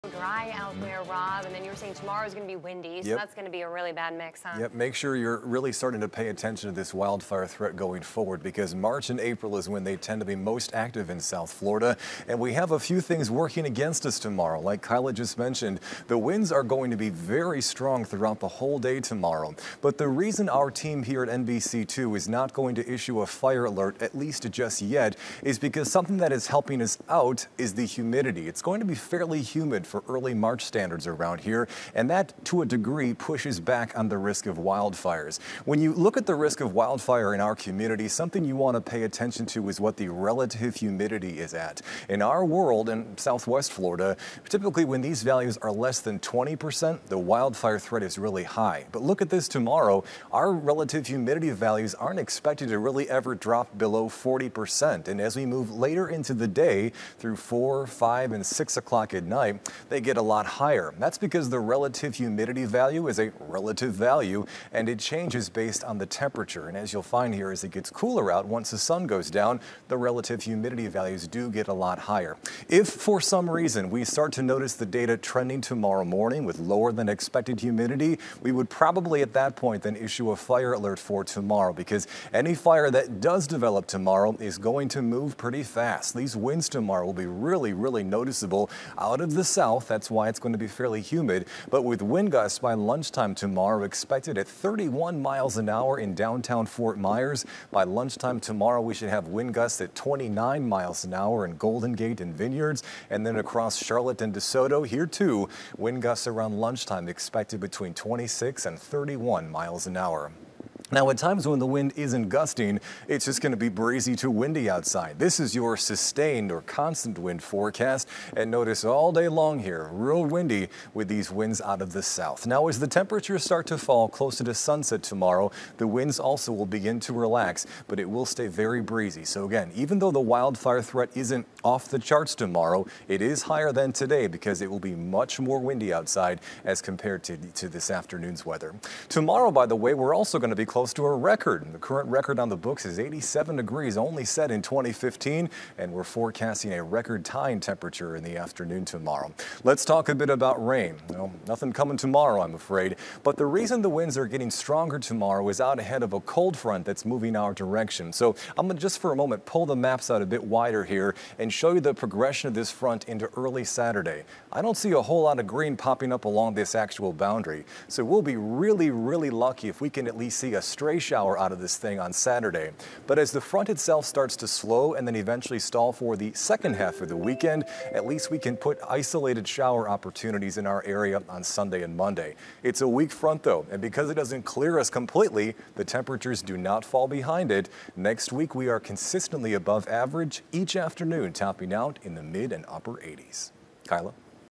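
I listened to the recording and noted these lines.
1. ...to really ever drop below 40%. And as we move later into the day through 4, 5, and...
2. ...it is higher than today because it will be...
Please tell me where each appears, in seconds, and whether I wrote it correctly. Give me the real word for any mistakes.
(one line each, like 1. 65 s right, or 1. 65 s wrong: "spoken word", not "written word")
1. 52 s right
2. 133 s right.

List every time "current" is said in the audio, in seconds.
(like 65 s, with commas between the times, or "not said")
141 s.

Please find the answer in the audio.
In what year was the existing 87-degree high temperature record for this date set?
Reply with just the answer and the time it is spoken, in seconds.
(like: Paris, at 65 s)
2015, at 144 s.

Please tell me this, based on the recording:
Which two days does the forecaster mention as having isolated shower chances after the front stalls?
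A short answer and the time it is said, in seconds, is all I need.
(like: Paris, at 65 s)
Sunday and Monday, at 181 s.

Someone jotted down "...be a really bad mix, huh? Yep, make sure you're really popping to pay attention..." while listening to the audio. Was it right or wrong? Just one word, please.
wrong.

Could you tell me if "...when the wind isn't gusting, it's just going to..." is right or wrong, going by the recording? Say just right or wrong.
right.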